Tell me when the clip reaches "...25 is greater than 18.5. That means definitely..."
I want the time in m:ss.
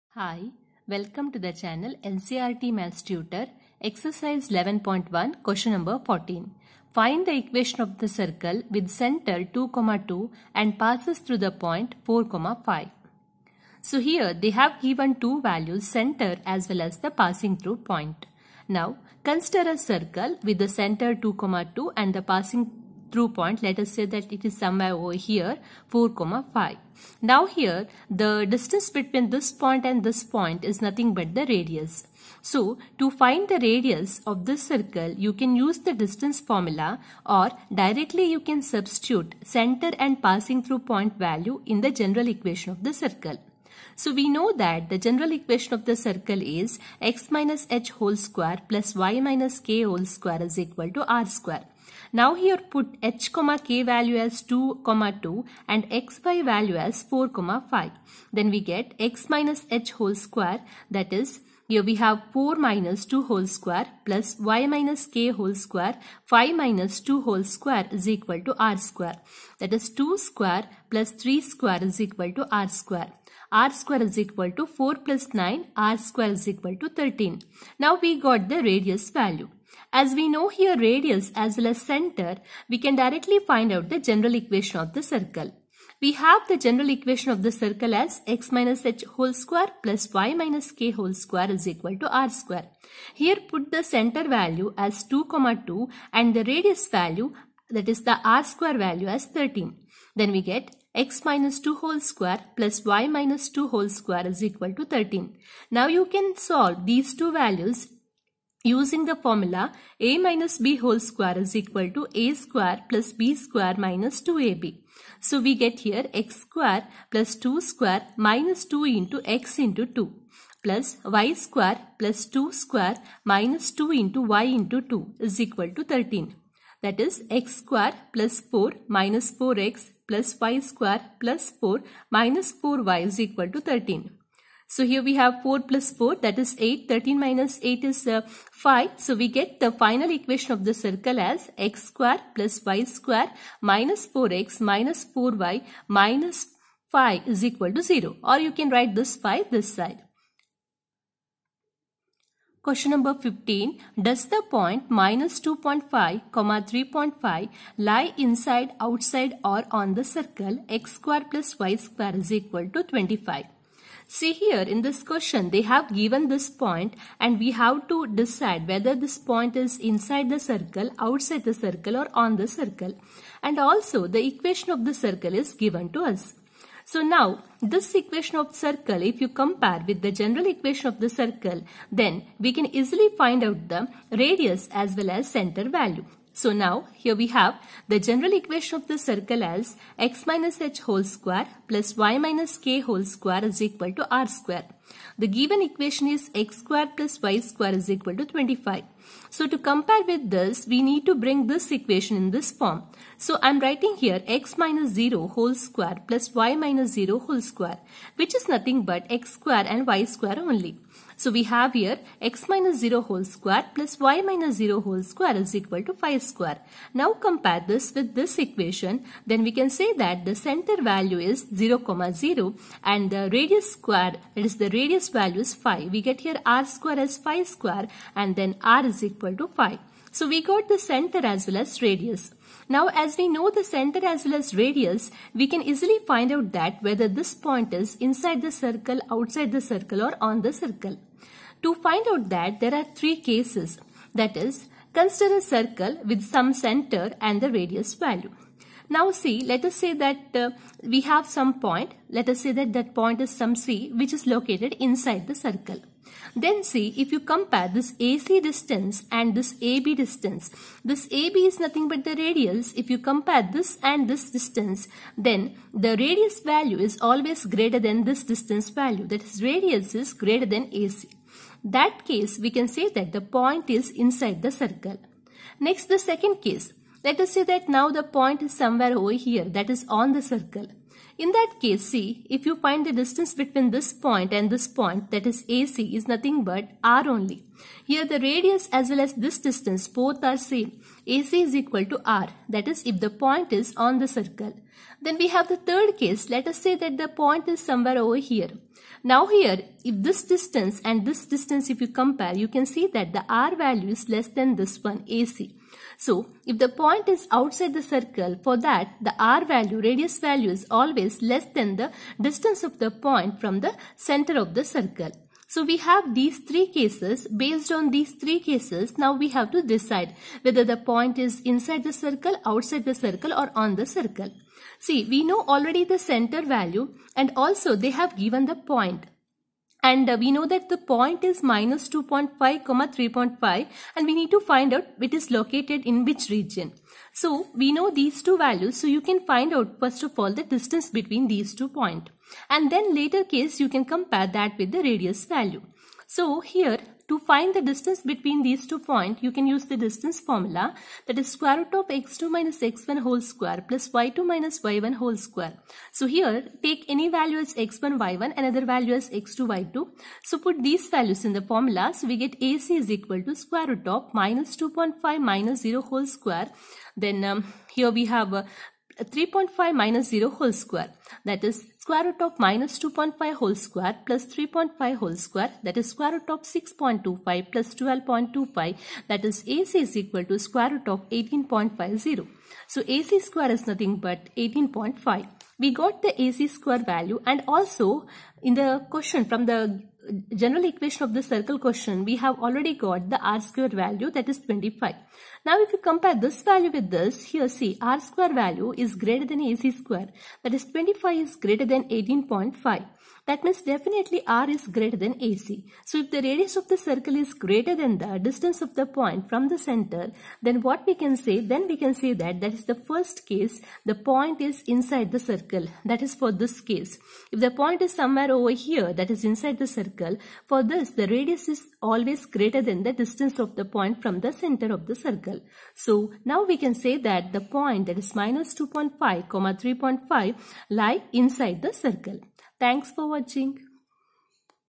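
6:40.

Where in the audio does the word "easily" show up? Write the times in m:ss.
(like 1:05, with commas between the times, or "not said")
3:02, 3:55.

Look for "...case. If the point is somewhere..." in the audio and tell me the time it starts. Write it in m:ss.
6:56.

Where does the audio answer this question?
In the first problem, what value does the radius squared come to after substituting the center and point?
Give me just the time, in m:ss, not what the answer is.
1:15.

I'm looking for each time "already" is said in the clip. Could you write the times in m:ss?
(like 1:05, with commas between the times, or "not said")
5:25, 6:32.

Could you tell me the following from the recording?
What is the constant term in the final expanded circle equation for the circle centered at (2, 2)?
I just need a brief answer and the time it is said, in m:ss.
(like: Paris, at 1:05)
minus 5, at 2:25.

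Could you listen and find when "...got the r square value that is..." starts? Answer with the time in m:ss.
6:32.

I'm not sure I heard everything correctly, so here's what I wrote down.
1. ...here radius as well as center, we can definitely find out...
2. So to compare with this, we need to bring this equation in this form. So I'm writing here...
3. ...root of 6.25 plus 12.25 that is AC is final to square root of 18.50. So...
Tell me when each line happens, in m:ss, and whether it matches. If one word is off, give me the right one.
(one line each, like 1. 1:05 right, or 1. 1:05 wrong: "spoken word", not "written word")
1. 1:20 wrong: "directly", not "definitely"
2. 3:19 right
3. 6:16 wrong: "equal", not "final".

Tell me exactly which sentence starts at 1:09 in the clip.
That is 2 square plus 3 square is equal to r square.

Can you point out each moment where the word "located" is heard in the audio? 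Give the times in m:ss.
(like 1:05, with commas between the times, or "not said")
4:14, 5:35.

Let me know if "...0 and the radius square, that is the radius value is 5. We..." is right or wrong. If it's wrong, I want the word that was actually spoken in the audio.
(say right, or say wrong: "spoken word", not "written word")
right.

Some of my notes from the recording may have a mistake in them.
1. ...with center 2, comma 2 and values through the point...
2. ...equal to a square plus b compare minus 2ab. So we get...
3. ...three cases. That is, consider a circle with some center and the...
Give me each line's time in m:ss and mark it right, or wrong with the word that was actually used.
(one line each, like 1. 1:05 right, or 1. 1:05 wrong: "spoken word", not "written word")
1. 0:08 wrong: "passes", not "values"
2. 1:51 wrong: "square", not "compare"
3. 4:02 right.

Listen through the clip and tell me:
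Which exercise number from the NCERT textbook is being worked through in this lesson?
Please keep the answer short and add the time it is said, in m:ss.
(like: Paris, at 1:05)
11.1, at 0:04.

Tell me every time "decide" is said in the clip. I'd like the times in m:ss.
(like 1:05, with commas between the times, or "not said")
2:48, 5:19.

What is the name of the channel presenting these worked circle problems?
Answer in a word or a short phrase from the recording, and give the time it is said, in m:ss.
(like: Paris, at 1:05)
NCERT Maths Tutor, at 0:02.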